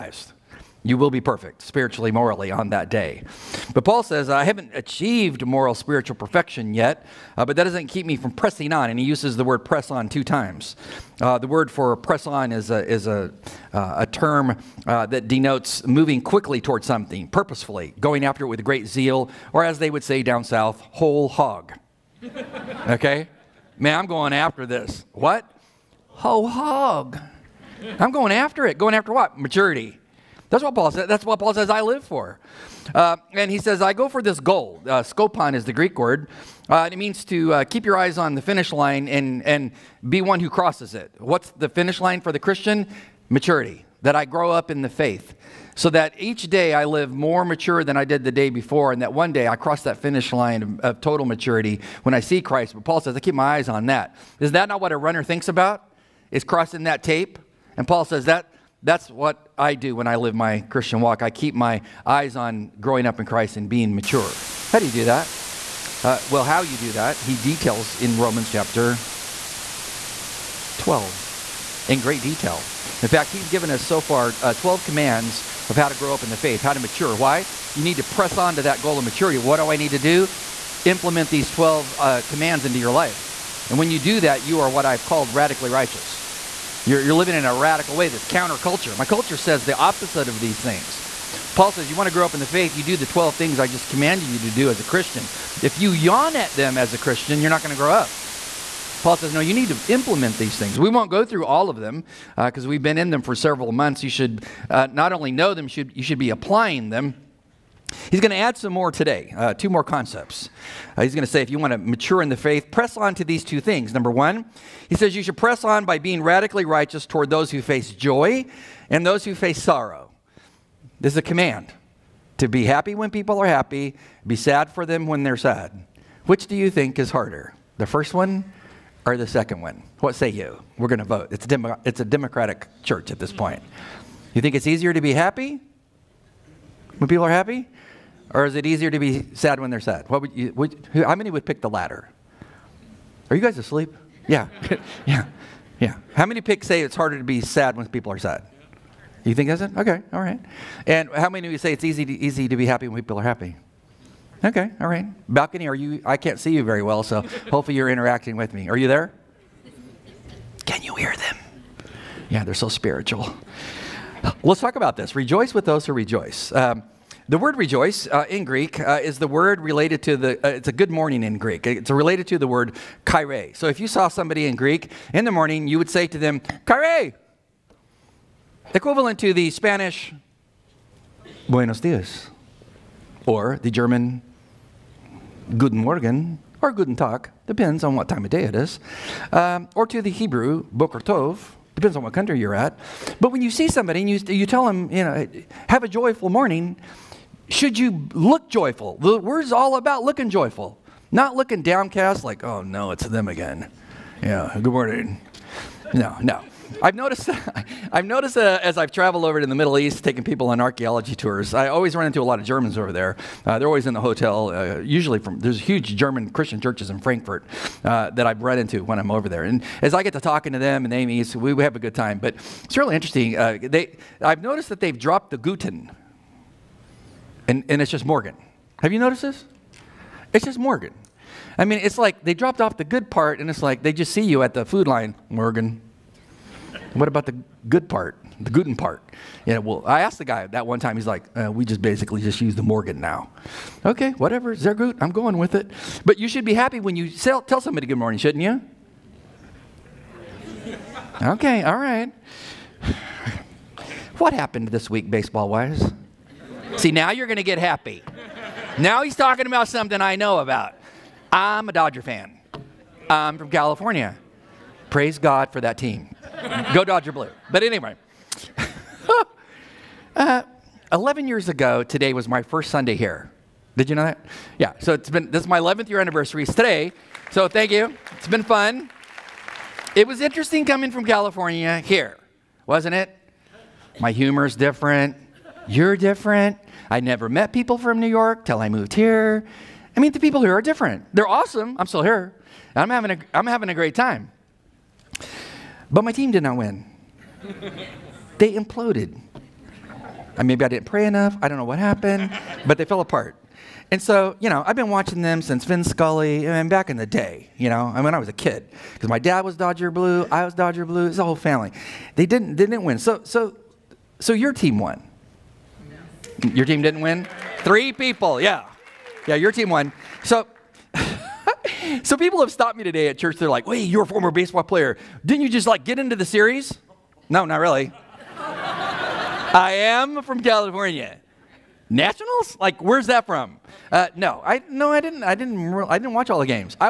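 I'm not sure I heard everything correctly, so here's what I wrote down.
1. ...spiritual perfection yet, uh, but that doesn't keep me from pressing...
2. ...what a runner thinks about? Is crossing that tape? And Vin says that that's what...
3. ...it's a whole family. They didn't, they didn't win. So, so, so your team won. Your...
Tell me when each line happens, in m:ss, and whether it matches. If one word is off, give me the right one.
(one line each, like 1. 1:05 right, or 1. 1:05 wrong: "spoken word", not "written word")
1. 0:05 right
2. 0:54 wrong: "Paul", not "Vin"
3. 5:11 right.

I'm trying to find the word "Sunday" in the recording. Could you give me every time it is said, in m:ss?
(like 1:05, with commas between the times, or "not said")
4:32.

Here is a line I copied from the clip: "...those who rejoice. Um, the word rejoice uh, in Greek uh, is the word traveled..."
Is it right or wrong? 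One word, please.
wrong.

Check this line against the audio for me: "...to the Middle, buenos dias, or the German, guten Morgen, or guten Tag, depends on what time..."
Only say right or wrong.
wrong.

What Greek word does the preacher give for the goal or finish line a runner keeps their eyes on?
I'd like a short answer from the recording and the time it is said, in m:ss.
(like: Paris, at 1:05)
skopon, at 0:35.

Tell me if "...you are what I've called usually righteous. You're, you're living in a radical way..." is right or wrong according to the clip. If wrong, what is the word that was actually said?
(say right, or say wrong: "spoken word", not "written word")
wrong: "radically", not "usually".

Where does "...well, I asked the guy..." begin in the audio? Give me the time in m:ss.
3:59.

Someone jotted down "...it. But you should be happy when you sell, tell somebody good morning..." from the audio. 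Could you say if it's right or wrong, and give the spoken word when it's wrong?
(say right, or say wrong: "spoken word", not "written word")
right.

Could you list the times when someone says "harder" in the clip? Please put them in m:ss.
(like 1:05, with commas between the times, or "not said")
2:07, 2:26.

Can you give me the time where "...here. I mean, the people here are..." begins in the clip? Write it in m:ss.
4:48.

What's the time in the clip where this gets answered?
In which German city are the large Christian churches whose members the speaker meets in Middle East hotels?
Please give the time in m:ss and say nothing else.
3:37.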